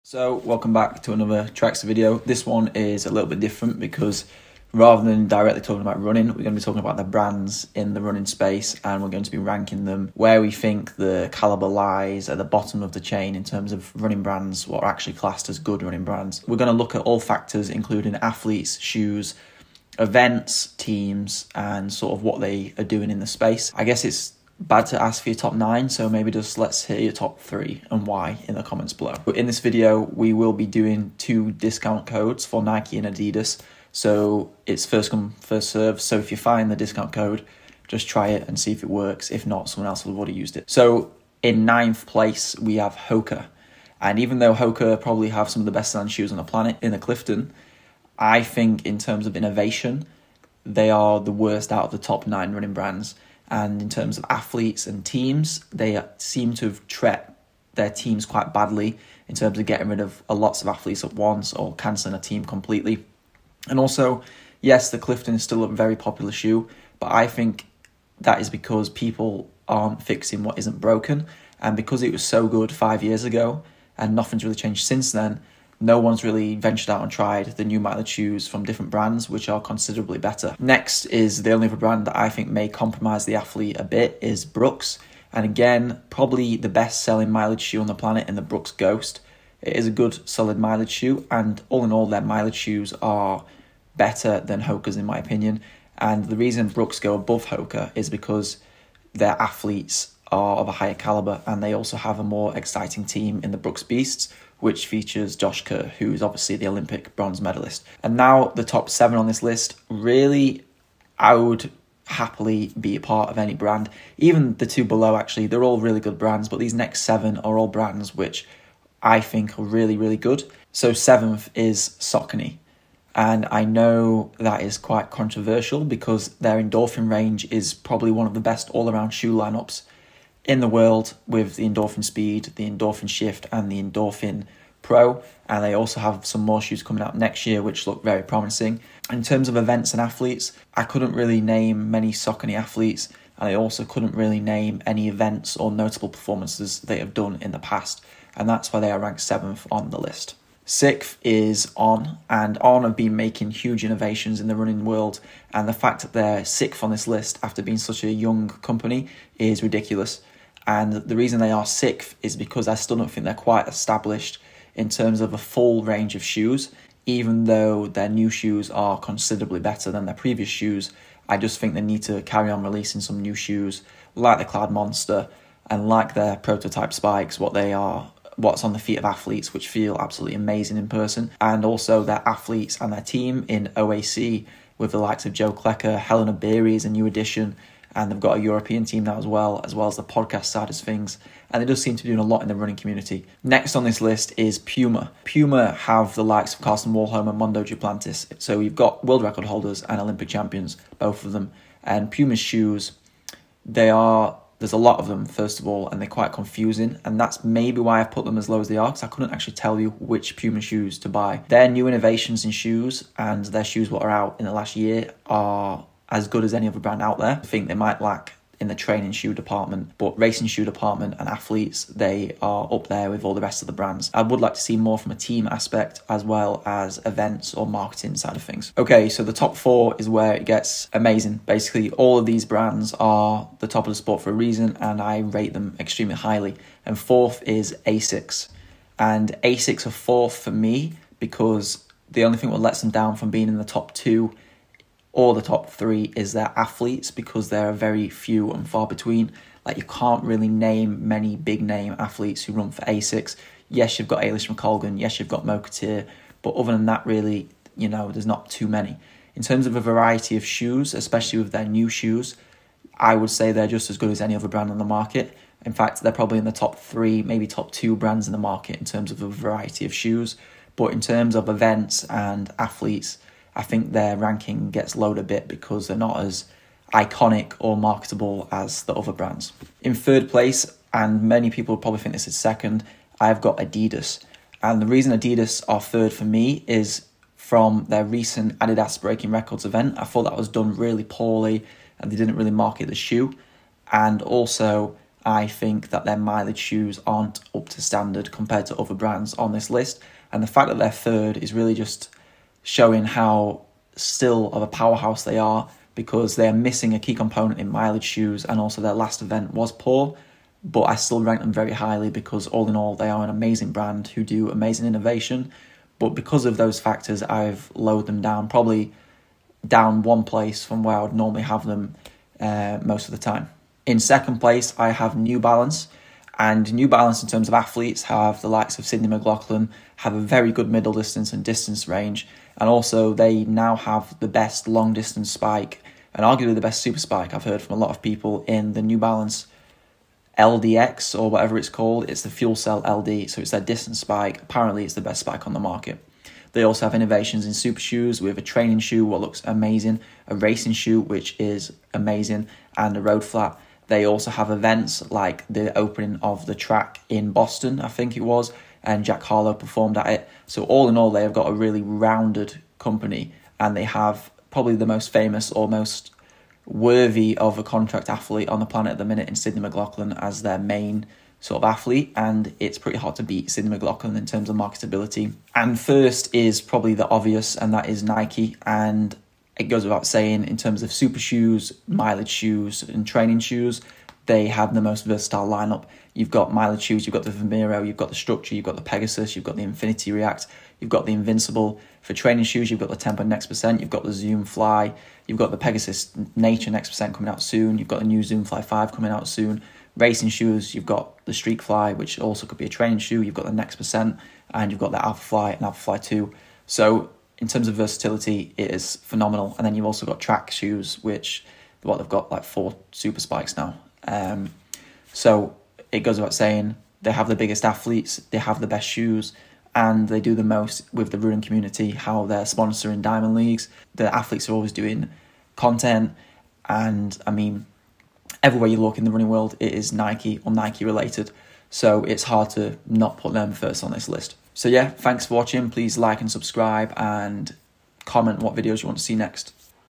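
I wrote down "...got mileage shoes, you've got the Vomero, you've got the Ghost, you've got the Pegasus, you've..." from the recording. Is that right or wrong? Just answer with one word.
wrong.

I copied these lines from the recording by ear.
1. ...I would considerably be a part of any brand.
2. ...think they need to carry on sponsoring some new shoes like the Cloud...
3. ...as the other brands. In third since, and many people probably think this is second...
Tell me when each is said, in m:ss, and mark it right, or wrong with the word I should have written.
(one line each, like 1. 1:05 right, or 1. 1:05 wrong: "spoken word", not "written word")
1. 1:51 wrong: "happily", not "considerably"
2. 2:51 wrong: "releasing", not "sponsoring"
3. 4:38 wrong: "place", not "since".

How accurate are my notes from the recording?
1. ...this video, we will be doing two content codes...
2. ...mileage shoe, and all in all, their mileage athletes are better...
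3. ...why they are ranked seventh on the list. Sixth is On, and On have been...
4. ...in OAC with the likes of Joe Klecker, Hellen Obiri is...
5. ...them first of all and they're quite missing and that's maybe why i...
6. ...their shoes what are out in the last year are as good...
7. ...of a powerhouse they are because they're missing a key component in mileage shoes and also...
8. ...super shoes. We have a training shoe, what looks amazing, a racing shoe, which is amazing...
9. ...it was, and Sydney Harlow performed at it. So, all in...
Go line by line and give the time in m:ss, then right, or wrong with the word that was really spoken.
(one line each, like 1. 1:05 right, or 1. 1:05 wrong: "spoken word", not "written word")
1. 0:29 wrong: "discount", not "content"
2. 1:30 wrong: "shoes", not "athletes"
3. 2:28 right
4. 3:03 right
5. 3:25 wrong: "confusing", not "missing"
6. 3:33 right
7. 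5:04 right
8. 5:47 right
9. 5:58 wrong: "Jack", not "Sydney".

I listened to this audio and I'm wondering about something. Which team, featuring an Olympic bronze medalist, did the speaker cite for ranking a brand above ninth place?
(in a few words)
Brooks Beasts.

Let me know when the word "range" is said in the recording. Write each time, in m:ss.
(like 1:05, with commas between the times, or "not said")
2:07, 2:45, 5:31.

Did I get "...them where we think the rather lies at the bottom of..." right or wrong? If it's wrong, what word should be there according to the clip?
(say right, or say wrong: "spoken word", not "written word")
wrong: "caliber", not "rather".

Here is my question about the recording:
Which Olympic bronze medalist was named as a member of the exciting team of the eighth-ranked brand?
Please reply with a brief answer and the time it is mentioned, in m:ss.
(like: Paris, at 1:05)
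Josh Kerr, at 1:45.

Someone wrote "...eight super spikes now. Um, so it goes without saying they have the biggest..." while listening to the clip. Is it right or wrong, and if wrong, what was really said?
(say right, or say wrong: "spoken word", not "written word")
wrong: "four", not "eight".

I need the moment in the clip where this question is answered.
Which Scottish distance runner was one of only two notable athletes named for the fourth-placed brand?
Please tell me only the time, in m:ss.
4:14.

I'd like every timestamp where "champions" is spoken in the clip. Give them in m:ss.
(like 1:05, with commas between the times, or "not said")
3:20.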